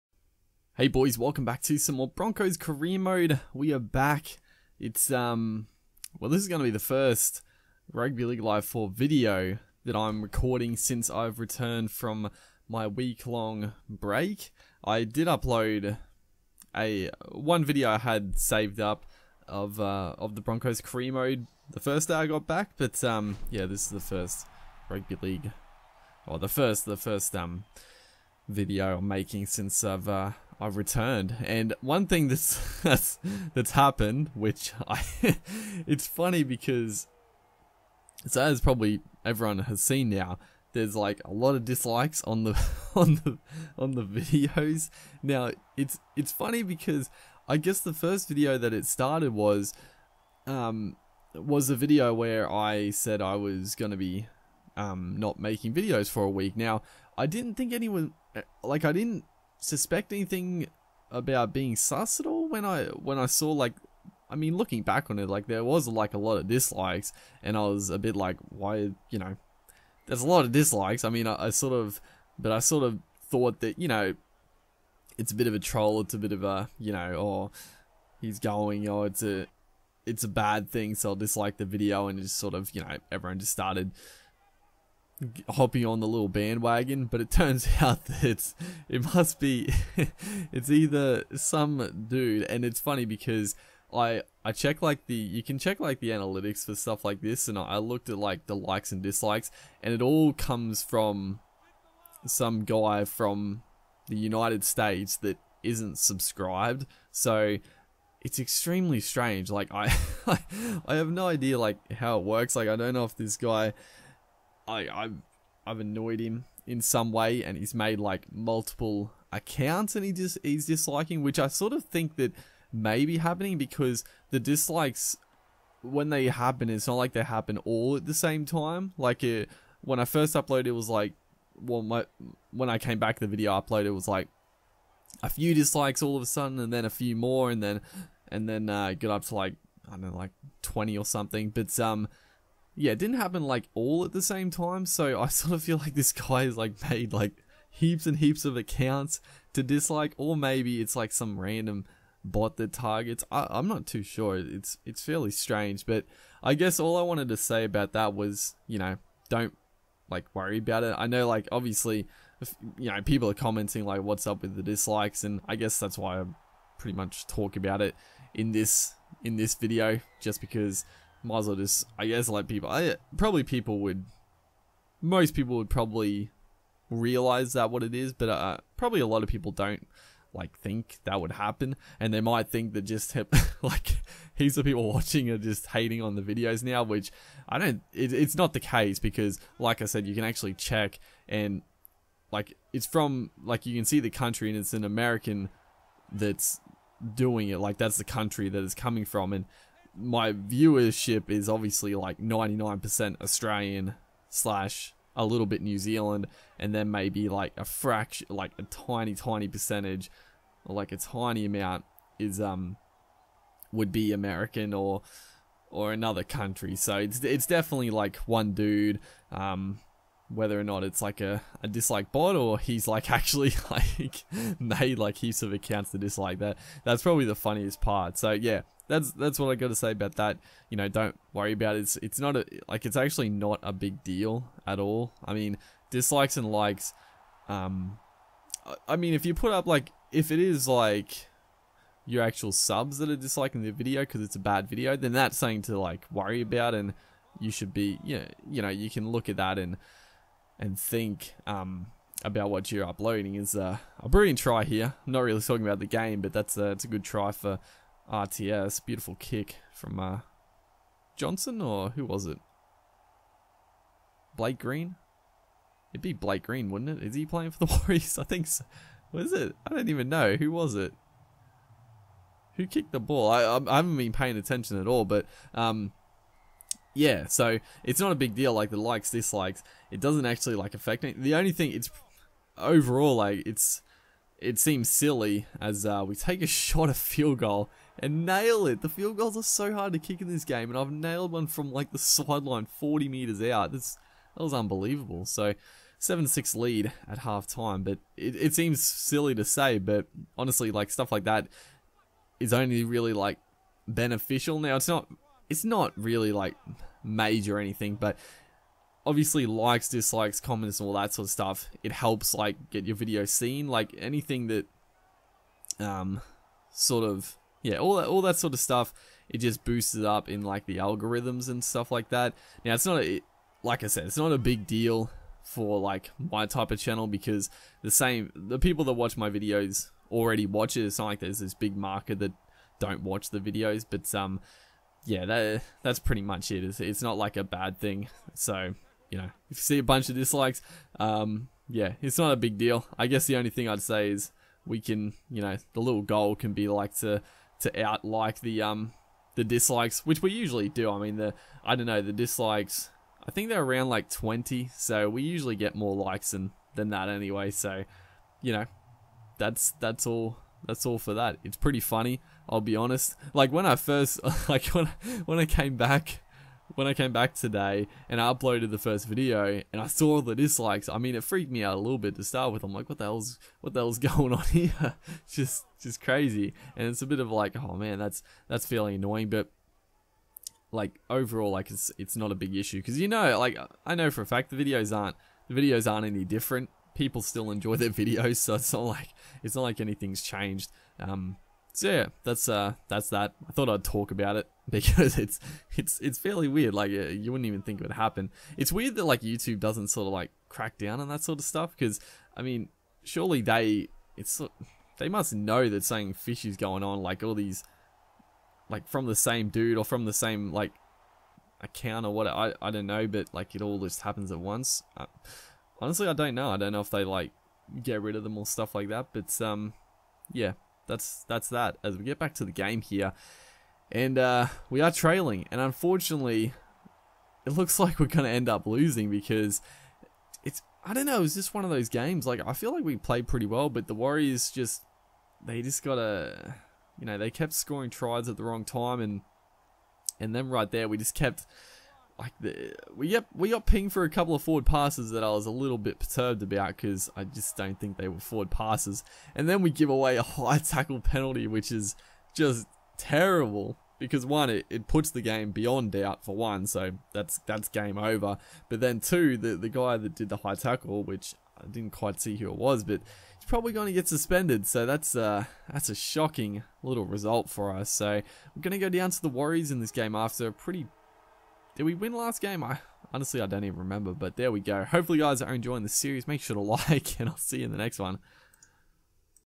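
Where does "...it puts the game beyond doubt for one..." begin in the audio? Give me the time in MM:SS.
07:34.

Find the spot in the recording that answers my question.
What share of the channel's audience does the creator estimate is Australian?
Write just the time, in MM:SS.
03:22.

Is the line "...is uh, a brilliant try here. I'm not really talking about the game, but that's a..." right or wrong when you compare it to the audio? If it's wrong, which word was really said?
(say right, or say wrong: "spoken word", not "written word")
right.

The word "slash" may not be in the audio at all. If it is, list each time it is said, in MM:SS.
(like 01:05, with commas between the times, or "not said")
03:24.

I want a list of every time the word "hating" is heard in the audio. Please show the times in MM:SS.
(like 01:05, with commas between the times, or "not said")
03:05.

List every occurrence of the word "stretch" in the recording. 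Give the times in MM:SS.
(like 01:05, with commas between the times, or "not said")
not said.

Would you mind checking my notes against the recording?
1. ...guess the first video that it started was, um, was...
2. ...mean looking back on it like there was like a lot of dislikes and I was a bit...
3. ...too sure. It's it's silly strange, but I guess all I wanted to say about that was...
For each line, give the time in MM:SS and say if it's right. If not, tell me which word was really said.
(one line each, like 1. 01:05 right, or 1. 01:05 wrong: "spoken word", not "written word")
1. 00:47 right
2. 01:04 right
3. 02:33 wrong: "fairly", not "silly".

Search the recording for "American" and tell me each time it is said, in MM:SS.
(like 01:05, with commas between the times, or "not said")
03:14, 03:34.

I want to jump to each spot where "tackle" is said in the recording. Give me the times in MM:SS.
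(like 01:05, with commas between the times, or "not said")
07:30, 07:40.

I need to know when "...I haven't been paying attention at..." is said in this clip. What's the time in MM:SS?
04:33.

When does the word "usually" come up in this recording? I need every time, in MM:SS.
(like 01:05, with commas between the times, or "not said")
05:50, 05:55.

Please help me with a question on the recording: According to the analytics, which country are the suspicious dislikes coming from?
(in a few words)
United States.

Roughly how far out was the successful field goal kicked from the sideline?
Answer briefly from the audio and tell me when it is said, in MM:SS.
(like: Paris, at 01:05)
40 meters, at 04:52.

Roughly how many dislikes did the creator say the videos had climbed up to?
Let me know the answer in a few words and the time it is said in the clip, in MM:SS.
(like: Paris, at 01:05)
20, at 02:20.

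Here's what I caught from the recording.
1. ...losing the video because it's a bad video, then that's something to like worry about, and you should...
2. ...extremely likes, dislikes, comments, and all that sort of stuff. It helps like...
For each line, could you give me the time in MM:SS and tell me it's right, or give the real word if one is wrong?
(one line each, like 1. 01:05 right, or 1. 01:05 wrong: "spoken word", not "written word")
1. 04:03 wrong: "disliking", not "losing"
2. 05:09 wrong: "obviously", not "extremely".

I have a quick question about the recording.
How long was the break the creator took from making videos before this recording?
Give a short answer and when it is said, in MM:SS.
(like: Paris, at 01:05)
a week, at 00:12.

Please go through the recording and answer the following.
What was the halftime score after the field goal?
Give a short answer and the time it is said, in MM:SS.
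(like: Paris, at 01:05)
7-6, at 04:55.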